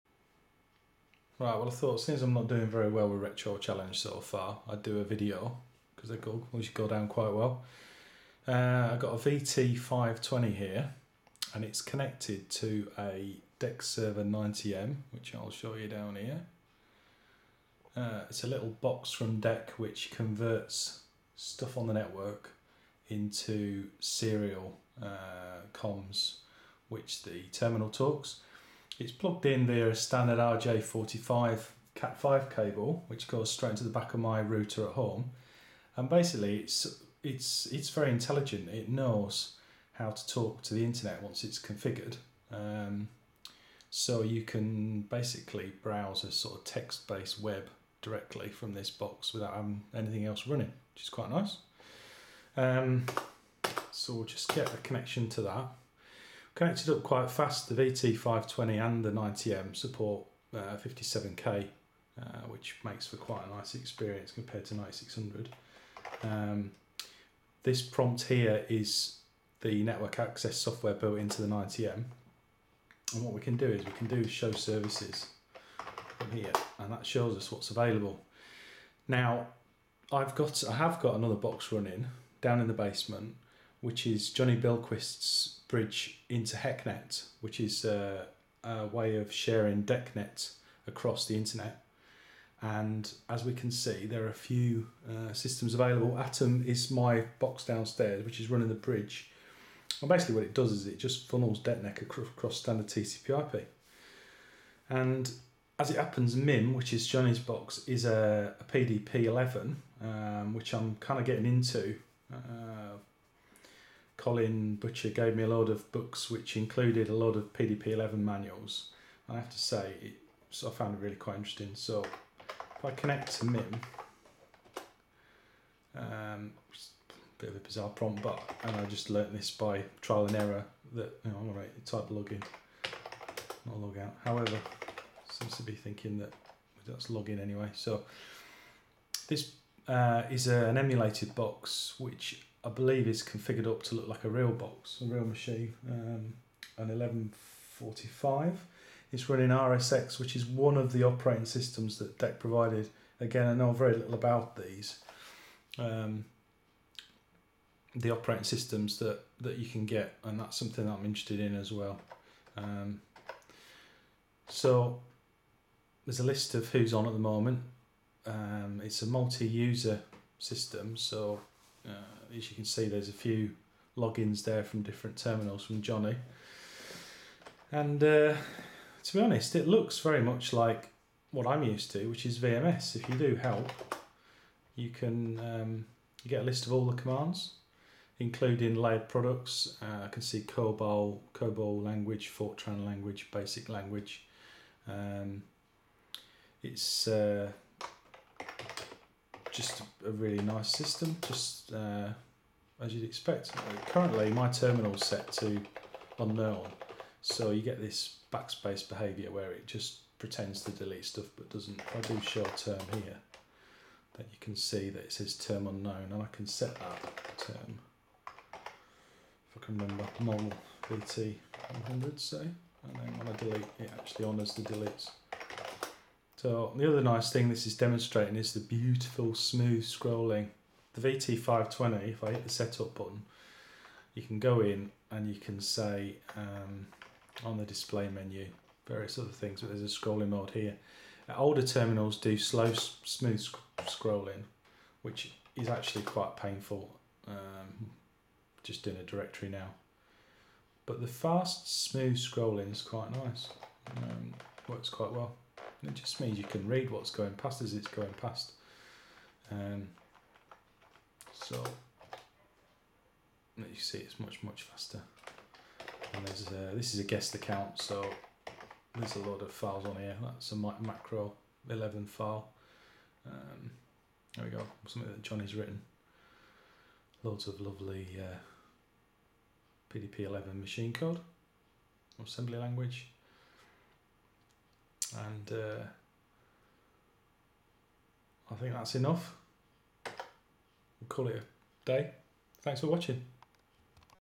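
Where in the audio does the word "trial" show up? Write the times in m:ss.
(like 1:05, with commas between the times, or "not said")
2:10.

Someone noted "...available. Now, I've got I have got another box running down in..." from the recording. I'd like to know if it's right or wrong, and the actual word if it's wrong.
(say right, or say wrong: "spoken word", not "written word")
right.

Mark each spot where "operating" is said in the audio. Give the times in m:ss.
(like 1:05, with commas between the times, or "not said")
2:31, 2:38.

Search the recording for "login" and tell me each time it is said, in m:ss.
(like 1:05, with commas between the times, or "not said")
2:12, 2:17, 2:53.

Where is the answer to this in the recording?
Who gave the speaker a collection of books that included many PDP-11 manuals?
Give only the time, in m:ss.
1:54.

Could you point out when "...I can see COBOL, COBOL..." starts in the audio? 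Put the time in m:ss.
3:10.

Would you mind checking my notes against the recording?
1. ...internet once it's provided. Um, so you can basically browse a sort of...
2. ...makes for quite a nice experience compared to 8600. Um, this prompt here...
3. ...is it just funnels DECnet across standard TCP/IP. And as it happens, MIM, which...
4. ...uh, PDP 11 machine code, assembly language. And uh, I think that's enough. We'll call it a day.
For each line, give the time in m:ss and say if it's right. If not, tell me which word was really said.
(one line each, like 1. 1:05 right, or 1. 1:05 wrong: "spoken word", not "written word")
1. 0:40 wrong: "configured", not "provided"
2. 1:02 wrong: "9600", not "8600"
3. 1:40 right
4. 4:38 right.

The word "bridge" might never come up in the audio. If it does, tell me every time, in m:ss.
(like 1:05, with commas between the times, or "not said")
1:25, 1:38.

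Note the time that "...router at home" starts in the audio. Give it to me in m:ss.
0:34.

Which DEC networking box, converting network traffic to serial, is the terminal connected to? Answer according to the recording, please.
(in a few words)
DECserver 90M.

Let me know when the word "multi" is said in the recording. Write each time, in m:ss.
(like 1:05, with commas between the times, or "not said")
2:49.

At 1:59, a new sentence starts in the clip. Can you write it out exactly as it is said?
I have to say, it, so I found it really quite interesting.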